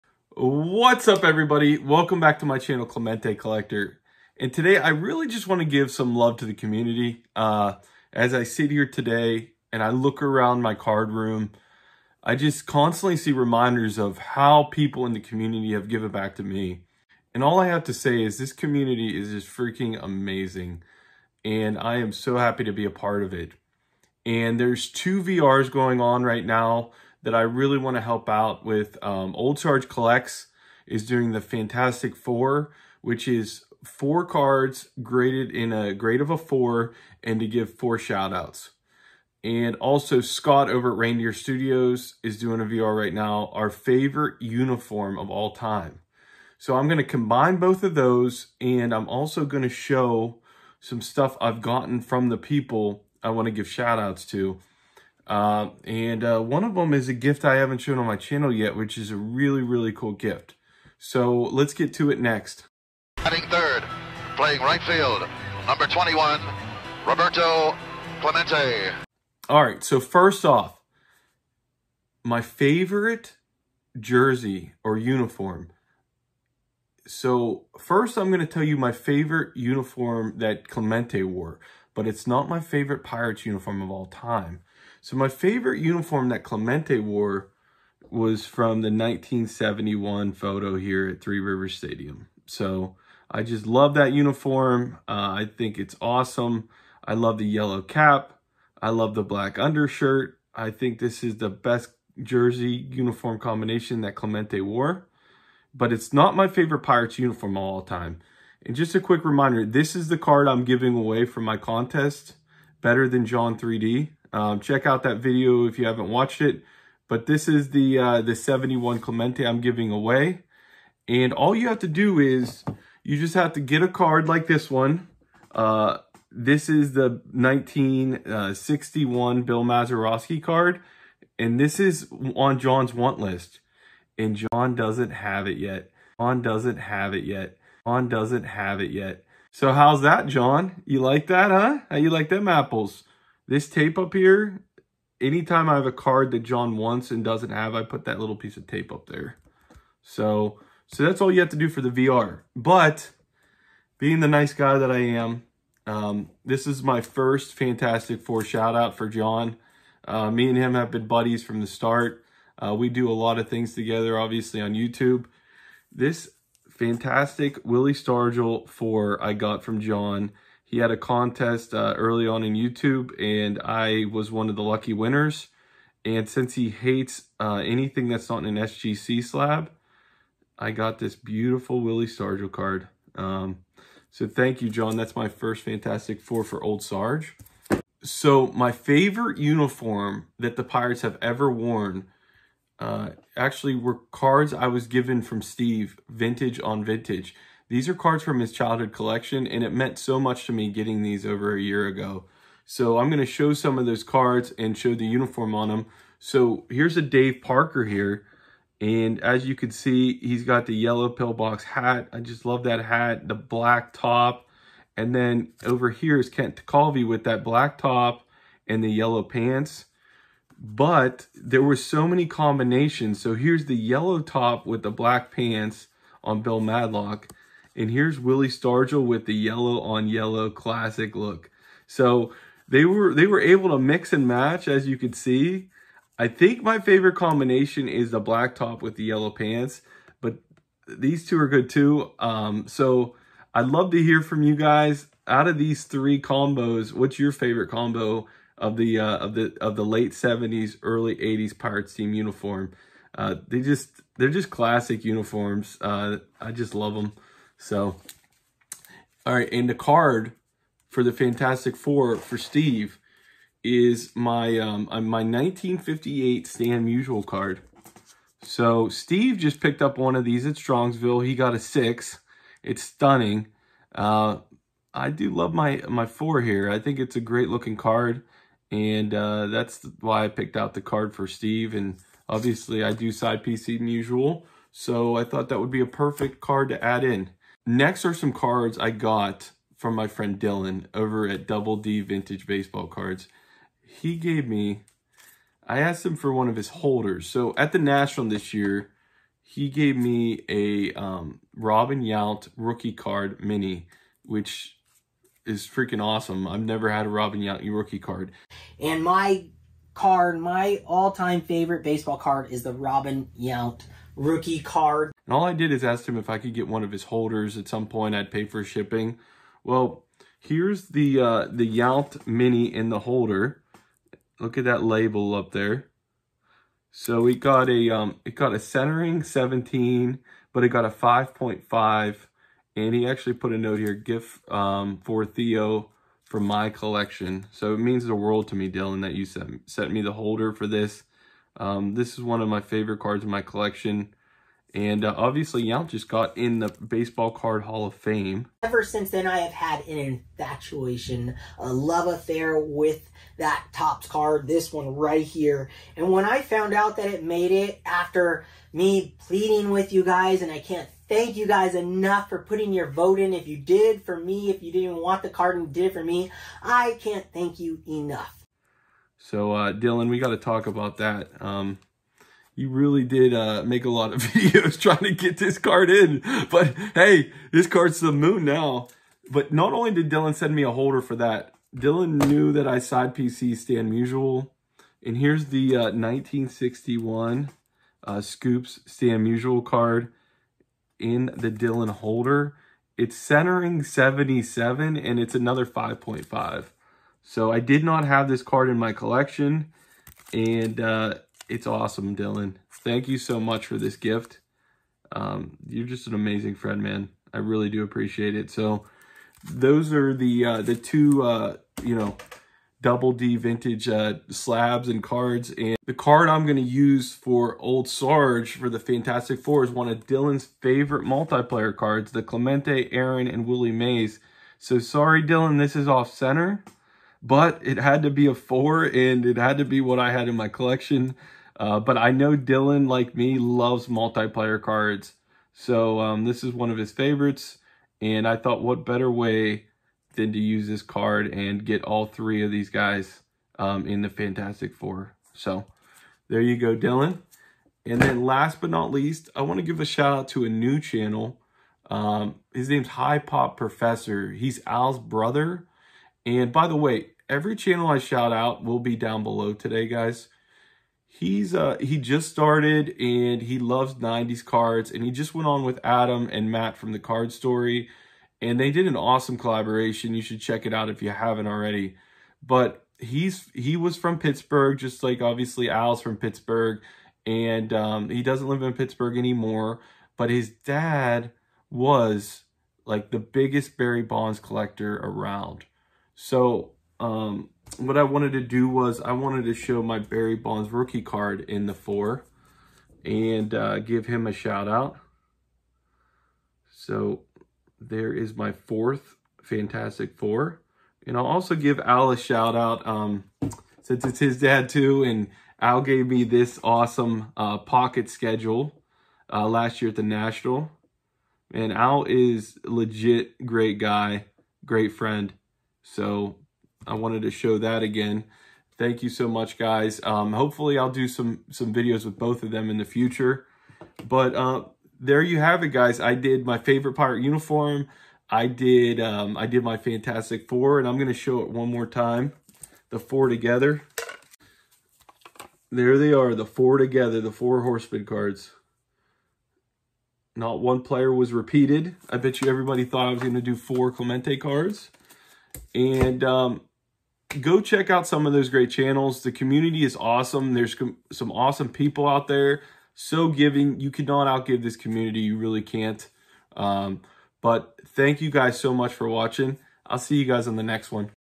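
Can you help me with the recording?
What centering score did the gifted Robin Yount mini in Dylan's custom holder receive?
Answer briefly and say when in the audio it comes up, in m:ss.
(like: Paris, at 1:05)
17, at 5:29.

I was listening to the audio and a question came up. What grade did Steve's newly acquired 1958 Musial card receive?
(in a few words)
6.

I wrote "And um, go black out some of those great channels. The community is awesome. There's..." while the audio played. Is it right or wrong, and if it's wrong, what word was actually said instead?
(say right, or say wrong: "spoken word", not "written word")
wrong: "check", not "black".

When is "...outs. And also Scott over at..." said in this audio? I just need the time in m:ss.
0:38.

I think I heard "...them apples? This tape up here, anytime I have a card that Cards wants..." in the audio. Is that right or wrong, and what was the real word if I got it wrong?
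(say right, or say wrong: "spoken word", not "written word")
wrong: "John", not "Cards".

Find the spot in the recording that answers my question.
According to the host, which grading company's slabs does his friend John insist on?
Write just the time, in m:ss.
2:58.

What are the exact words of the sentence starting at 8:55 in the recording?
There they are, the four together, the four horseman cards.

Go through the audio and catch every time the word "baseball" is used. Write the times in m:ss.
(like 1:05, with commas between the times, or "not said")
4:52, 5:11, 5:46.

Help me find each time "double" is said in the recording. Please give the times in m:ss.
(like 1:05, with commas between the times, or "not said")
4:51, 6:52.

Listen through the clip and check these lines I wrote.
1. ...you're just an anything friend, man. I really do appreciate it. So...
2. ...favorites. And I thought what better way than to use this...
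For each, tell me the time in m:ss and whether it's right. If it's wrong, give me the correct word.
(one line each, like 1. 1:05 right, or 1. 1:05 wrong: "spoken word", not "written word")
1. 6:45 wrong: "amazing", not "anything"
2. 7:16 right.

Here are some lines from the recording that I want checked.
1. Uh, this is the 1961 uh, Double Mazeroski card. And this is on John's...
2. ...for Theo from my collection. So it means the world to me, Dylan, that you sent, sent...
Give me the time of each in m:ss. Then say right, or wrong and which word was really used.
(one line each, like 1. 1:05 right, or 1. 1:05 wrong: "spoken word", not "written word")
1. 2:05 wrong: "Bill", not "Double"
2. 5:35 right.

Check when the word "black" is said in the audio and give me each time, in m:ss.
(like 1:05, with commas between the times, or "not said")
1:39, 3:33, 3:37, 3:44, 3:58.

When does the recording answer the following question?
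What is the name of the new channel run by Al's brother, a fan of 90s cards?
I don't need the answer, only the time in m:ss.
7:32.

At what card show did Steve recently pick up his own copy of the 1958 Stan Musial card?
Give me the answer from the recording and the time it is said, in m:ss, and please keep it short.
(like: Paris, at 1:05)
Strongsville, at 4:30.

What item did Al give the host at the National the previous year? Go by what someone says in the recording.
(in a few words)
pocket schedule.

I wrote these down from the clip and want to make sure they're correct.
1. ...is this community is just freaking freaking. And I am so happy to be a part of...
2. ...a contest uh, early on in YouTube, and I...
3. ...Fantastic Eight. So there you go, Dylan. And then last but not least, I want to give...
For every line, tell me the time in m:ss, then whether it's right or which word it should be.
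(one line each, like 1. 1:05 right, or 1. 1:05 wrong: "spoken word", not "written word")
1. 0:18 wrong: "amazing", not "freaking"
2. 2:50 right
3. 7:24 wrong: "Four", not "Eight".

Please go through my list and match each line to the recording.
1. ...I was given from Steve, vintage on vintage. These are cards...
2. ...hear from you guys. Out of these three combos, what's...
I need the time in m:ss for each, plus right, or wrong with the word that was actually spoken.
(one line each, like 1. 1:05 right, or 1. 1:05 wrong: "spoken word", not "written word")
1. 3:14 right
2. 4:04 right.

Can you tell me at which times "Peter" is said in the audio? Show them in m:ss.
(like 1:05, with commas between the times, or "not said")
not said.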